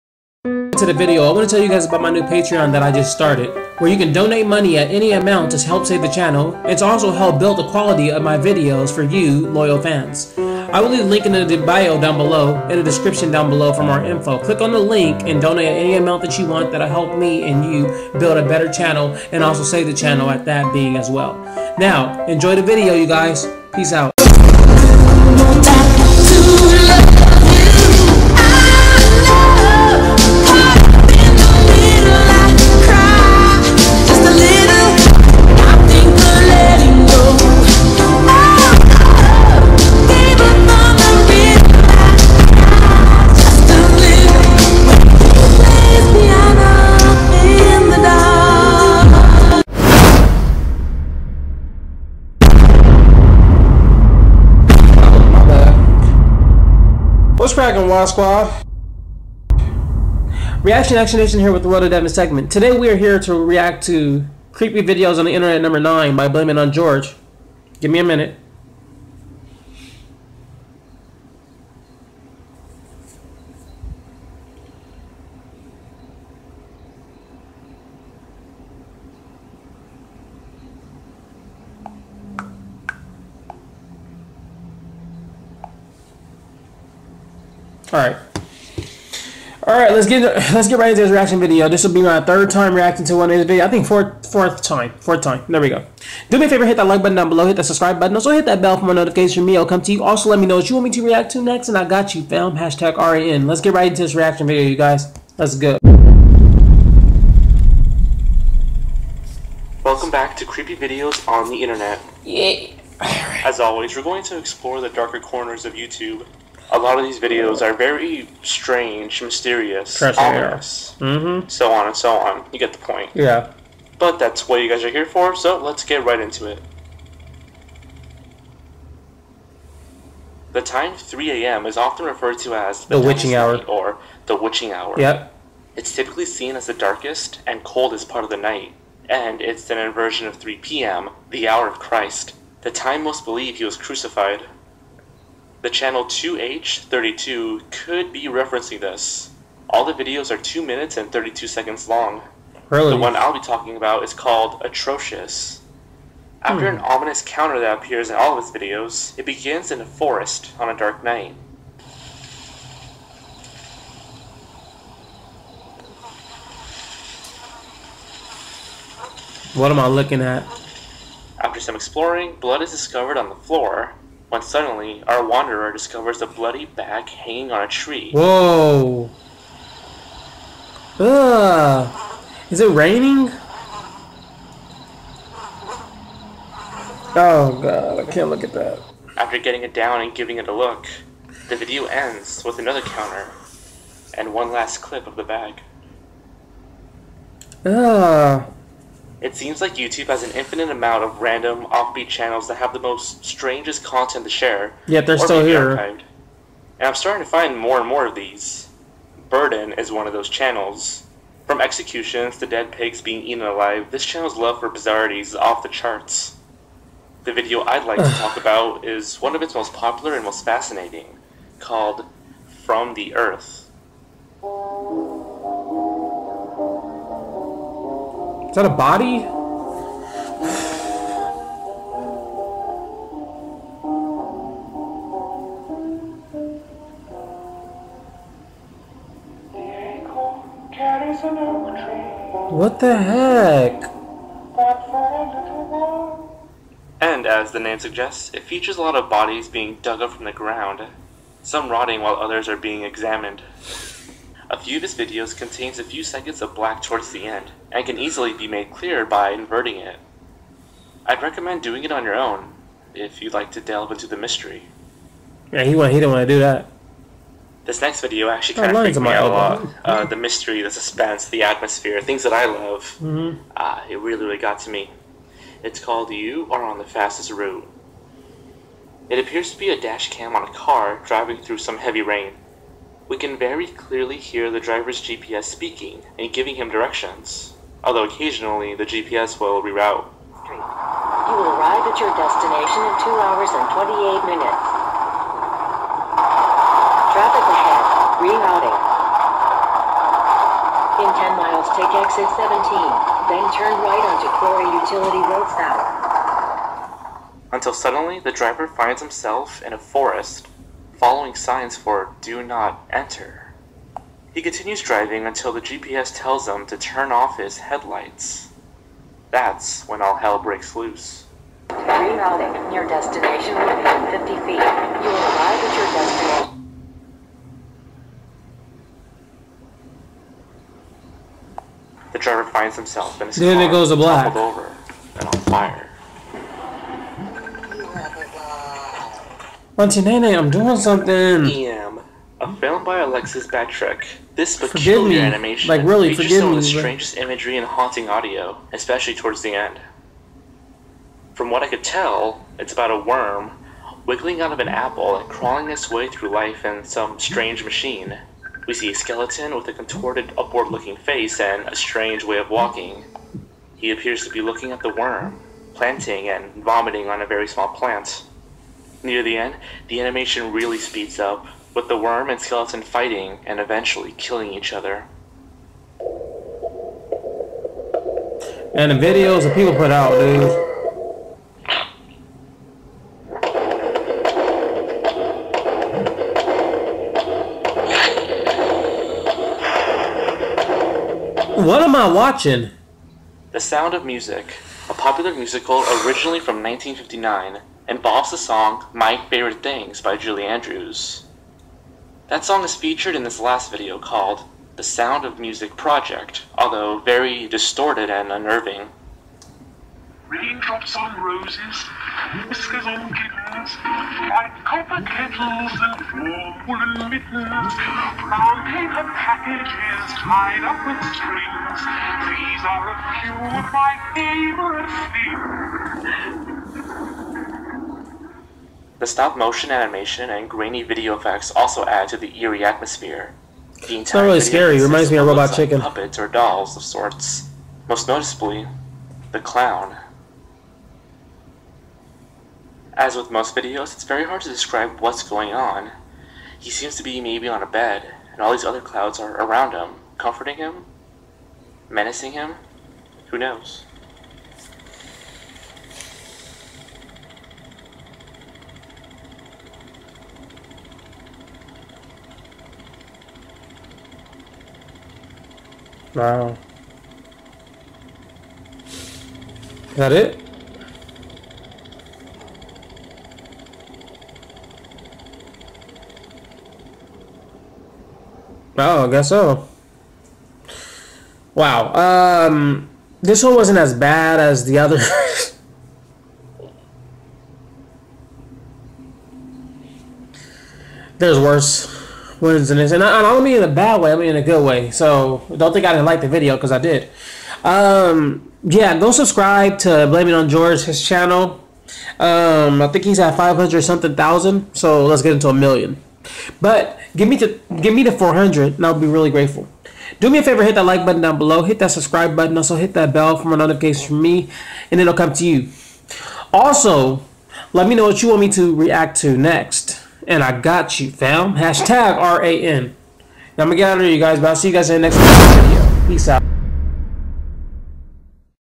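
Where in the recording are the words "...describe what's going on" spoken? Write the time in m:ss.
7:24.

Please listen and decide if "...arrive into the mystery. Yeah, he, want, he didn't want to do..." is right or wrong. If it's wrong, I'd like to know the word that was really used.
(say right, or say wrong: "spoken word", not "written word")
wrong: "delve", not "arrive".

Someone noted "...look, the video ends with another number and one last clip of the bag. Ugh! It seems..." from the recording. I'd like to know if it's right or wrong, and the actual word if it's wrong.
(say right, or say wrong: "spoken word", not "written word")
wrong: "counter", not "number".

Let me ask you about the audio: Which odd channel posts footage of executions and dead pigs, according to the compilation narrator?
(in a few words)
Burden.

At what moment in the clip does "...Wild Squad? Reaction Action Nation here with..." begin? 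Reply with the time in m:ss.
0:57.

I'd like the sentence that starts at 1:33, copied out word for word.
I think fourth fourth time, fourth time.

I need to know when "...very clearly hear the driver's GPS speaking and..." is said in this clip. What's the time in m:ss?
4:43.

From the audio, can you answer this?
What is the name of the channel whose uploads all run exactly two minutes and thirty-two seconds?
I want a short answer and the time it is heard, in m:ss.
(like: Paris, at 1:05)
2H32, at 2:26.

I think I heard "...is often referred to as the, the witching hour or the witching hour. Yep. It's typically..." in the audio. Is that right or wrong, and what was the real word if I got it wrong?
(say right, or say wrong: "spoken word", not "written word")
right.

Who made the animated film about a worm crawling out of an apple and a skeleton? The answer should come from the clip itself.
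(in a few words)
Alexis Batrick.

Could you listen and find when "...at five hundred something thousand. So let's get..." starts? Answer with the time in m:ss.
8:23.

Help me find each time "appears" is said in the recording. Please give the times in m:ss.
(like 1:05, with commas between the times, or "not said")
2:37, 4:39, 6:03.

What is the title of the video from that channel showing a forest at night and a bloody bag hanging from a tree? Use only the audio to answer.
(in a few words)
Atrocious.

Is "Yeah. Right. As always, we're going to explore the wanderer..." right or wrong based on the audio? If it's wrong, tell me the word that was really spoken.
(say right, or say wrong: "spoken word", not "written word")
wrong: "darker", not "wanderer".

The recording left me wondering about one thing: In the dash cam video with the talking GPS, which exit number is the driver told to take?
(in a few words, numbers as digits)
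17.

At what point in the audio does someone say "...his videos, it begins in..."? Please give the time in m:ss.
2:38.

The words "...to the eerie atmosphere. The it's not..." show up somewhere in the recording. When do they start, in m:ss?
7:12.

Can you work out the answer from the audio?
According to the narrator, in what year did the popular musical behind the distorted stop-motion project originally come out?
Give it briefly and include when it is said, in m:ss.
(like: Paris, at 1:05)
1959, at 6:36.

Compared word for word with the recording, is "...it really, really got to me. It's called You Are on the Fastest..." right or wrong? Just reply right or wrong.
right.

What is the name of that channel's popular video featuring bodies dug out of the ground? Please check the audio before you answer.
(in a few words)
From the Earth.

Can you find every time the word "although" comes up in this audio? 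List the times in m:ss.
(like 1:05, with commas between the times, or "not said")
4:47, 6:46.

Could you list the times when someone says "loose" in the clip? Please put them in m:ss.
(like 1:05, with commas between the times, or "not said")
5:20.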